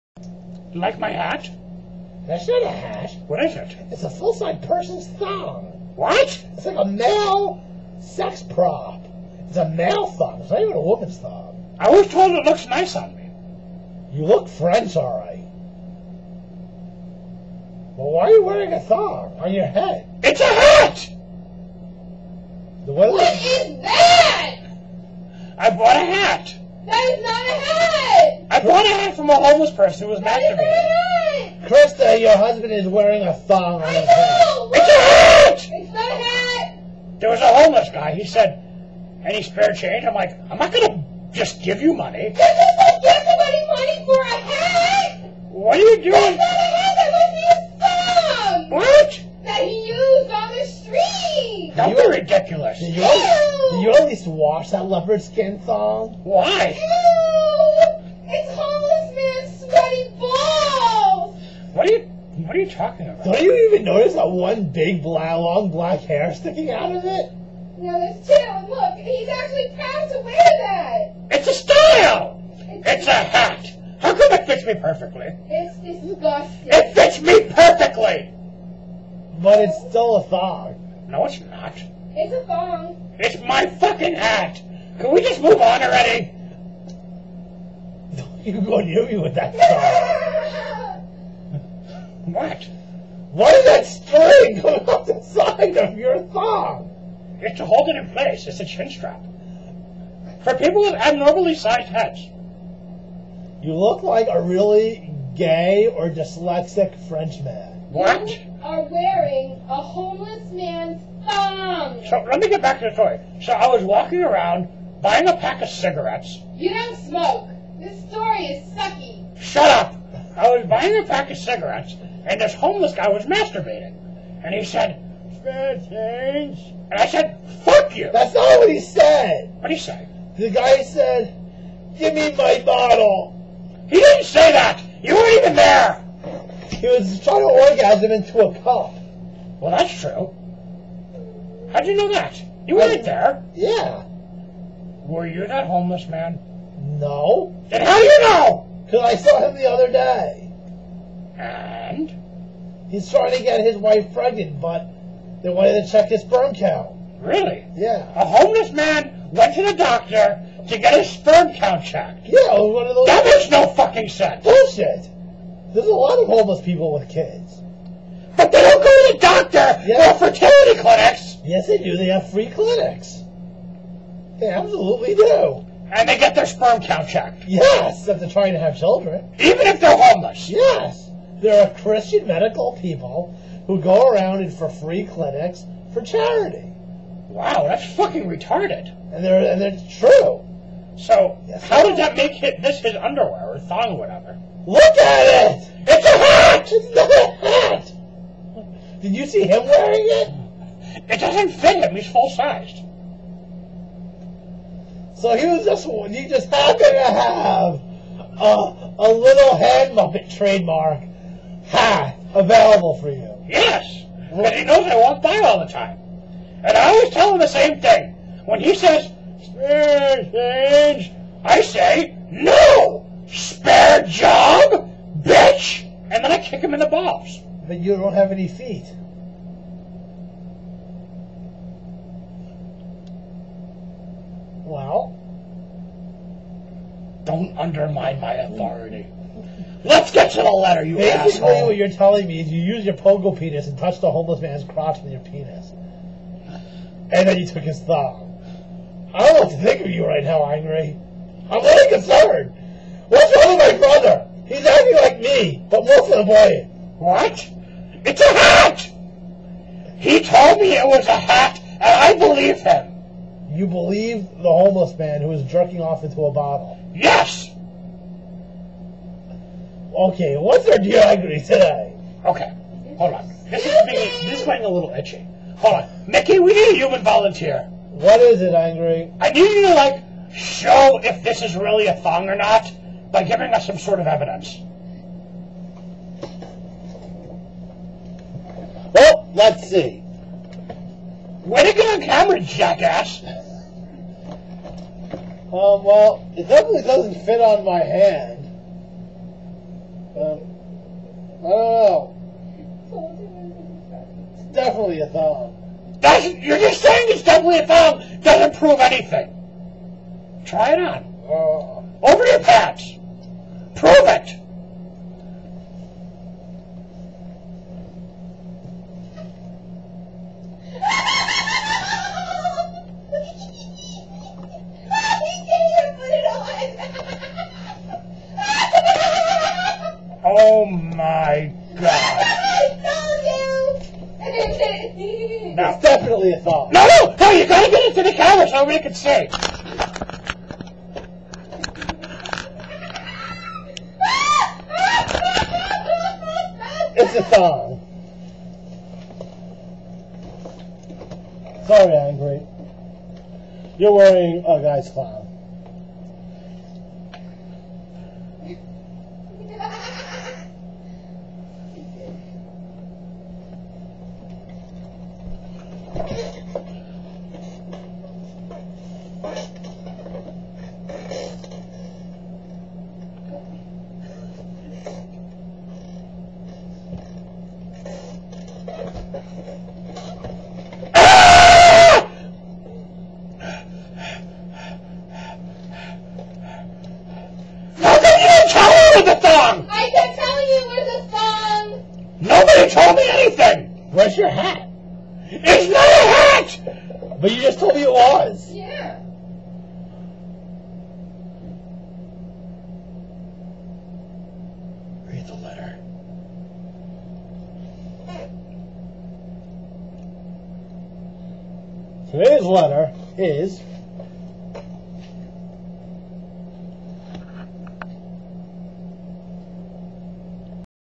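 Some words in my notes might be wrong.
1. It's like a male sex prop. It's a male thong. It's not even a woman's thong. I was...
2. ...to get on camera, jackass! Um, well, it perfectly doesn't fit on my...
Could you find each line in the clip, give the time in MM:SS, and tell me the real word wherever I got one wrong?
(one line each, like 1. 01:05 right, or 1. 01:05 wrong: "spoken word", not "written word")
1. 00:06 right
2. 04:51 wrong: "definitely", not "perfectly".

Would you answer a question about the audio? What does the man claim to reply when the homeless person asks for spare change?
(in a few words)
Spare job.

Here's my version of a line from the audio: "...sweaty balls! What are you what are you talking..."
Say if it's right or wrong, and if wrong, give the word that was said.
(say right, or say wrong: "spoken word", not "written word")
right.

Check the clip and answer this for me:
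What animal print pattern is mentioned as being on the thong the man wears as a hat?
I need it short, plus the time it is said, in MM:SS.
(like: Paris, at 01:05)
Leopard skin, at 00:54.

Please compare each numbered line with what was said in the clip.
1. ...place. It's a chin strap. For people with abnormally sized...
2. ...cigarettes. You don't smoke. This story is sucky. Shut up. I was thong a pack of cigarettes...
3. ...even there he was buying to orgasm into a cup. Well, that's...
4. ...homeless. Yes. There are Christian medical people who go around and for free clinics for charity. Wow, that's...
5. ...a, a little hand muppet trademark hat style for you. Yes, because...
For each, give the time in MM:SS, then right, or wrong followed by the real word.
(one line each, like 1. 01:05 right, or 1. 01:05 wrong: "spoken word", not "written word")
1. 01:38 right
2. 01:55 wrong: "buying", not "thong"
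3. 02:15 wrong: "trying", not "buying"
4. 02:59 right
5. 03:28 wrong: "available", not "style".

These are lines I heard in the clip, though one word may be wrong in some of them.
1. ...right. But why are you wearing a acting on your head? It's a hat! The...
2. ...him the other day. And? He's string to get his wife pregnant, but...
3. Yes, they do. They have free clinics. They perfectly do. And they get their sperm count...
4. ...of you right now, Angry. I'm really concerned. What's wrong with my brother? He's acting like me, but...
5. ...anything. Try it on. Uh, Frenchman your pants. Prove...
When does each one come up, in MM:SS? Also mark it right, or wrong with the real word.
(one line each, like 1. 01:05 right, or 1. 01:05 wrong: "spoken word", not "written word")
1. 00:15 wrong: "thong", not "acting"
2. 02:29 wrong: "trying", not "string"
3. 02:51 wrong: "absolutely", not "perfectly"
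4. 04:09 right
5. 05:08 wrong: "Over", not "Frenchman".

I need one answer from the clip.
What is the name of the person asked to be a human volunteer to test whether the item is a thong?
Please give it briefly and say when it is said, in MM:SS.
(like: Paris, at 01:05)
Mickey, at 04:36.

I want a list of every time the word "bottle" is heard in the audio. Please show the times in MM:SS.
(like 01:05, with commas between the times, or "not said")
02:12, 04:26.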